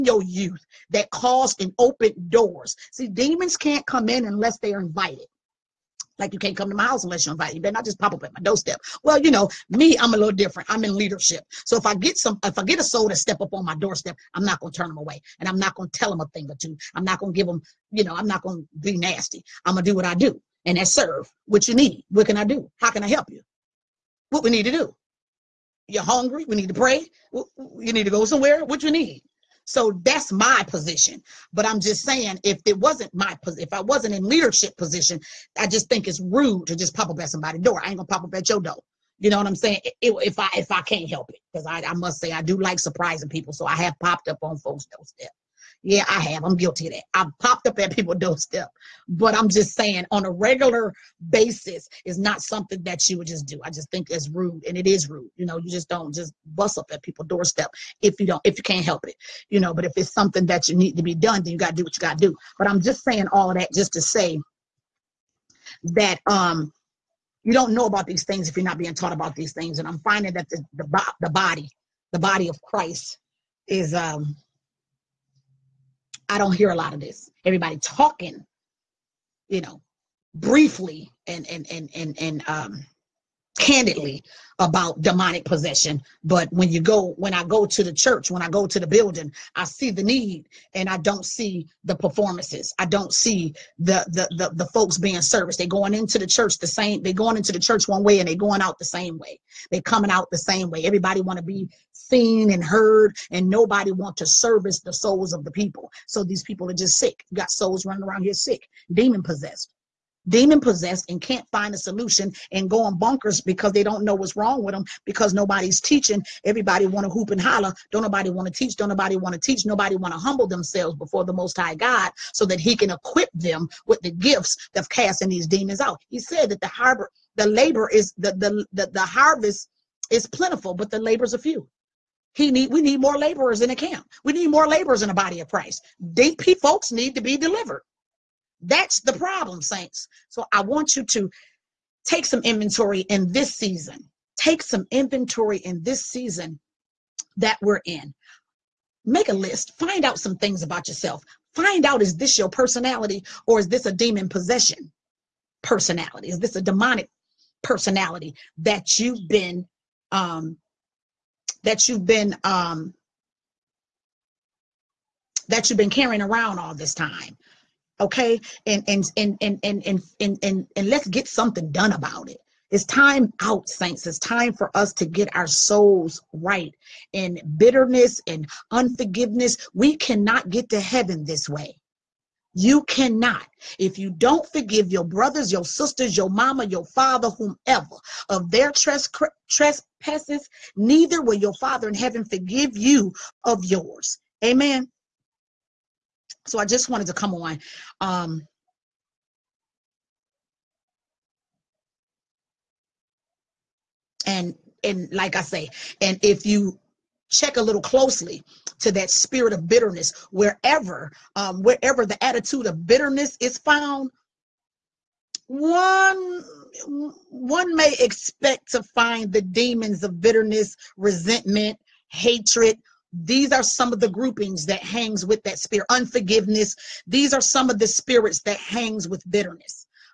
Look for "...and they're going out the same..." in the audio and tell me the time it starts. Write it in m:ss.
1:38.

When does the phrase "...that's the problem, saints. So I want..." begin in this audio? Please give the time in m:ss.
2:18.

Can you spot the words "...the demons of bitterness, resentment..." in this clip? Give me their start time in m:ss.
3:39.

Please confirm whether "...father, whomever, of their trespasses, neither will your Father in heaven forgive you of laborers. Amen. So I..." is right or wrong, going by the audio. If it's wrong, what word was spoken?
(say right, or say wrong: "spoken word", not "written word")
wrong: "yours", not "laborers".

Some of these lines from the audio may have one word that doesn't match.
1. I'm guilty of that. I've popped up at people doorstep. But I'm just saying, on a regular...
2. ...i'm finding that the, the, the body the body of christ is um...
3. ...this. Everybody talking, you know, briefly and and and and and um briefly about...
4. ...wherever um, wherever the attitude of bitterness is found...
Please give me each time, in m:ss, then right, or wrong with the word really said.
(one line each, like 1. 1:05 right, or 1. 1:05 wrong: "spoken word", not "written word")
1. 0:46 right
2. 1:09 right
3. 1:17 wrong: "candidly", not "briefly"
4. 3:30 right.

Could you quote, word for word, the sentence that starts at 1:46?
So these people are just sick.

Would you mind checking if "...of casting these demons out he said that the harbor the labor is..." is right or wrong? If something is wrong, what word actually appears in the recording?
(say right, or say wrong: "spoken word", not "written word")
right.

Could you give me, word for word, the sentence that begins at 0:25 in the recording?
You're hungry, we need to pray, you need to go somewhere, what you need.